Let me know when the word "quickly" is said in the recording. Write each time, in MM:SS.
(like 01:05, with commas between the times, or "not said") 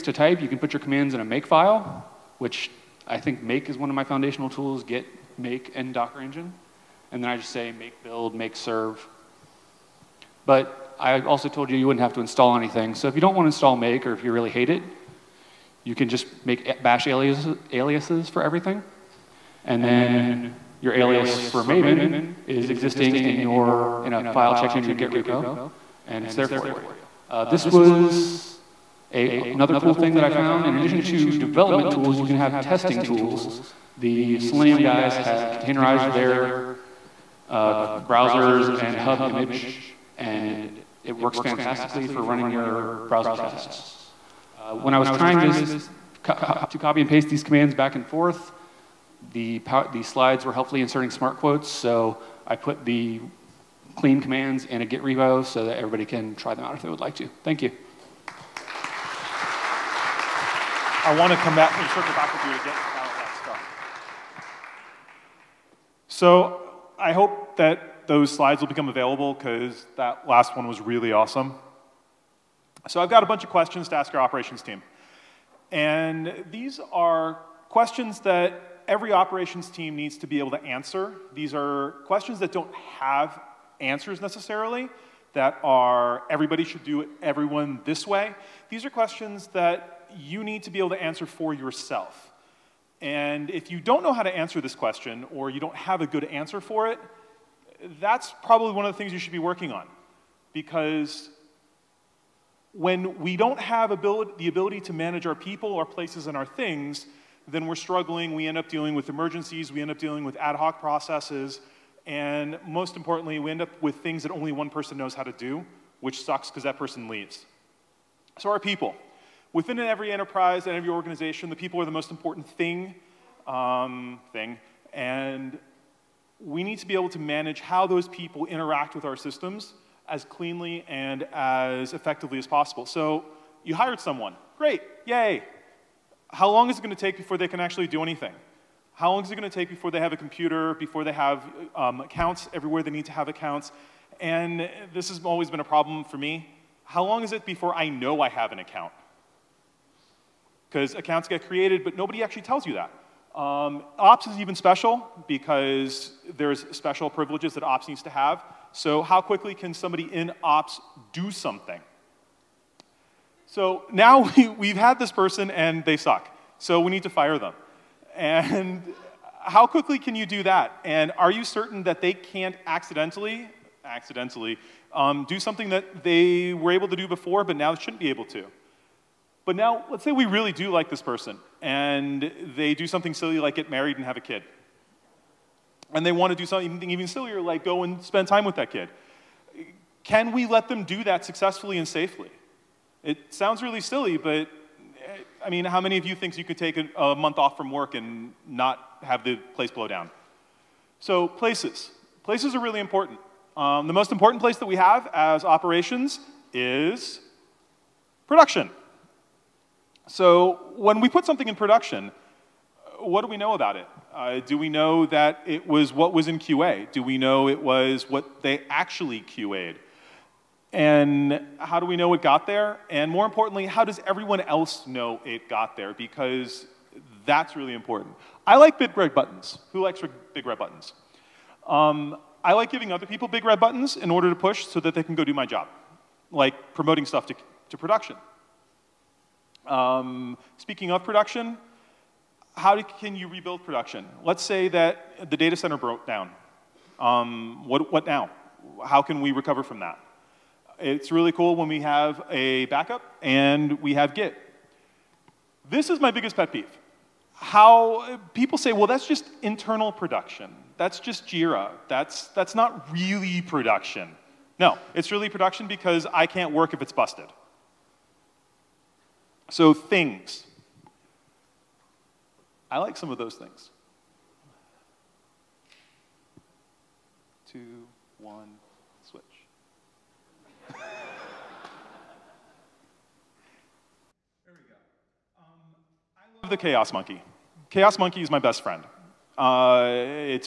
02:39, 02:49.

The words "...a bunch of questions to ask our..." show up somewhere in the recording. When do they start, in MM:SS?
01:13.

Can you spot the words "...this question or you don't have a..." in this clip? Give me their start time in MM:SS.
01:34.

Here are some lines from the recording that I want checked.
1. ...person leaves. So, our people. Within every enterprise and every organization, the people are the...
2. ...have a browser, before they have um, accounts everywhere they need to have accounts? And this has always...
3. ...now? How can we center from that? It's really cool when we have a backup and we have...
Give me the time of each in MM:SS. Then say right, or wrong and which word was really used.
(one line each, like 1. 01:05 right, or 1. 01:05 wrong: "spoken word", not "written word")
1. 01:56 right
2. 02:19 wrong: "computer", not "browser"
3. 04:08 wrong: "recover", not "center".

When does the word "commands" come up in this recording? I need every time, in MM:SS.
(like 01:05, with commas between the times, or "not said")
00:00, 00:47, 00:54.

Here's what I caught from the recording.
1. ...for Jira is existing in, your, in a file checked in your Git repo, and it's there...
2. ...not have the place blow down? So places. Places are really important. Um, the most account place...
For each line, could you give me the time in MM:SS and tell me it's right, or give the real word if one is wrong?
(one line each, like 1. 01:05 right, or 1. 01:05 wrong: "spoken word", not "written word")
1. 00:21 wrong: "Maven", not "Jira"
2. 03:18 wrong: "important", not "account".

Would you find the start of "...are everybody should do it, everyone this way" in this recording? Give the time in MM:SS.
01:25.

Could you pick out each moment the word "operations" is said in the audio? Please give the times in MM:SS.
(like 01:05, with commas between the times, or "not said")
01:14, 01:19, 03:25.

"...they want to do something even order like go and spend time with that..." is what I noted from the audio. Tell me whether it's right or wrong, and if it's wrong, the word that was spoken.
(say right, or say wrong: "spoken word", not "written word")
wrong: "sillier", not "order".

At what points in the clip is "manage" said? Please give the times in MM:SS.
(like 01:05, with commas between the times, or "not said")
01:44, 02:07.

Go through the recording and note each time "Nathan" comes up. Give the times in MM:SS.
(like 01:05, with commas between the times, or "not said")
not said.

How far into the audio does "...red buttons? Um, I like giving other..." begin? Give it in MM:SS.
03:50.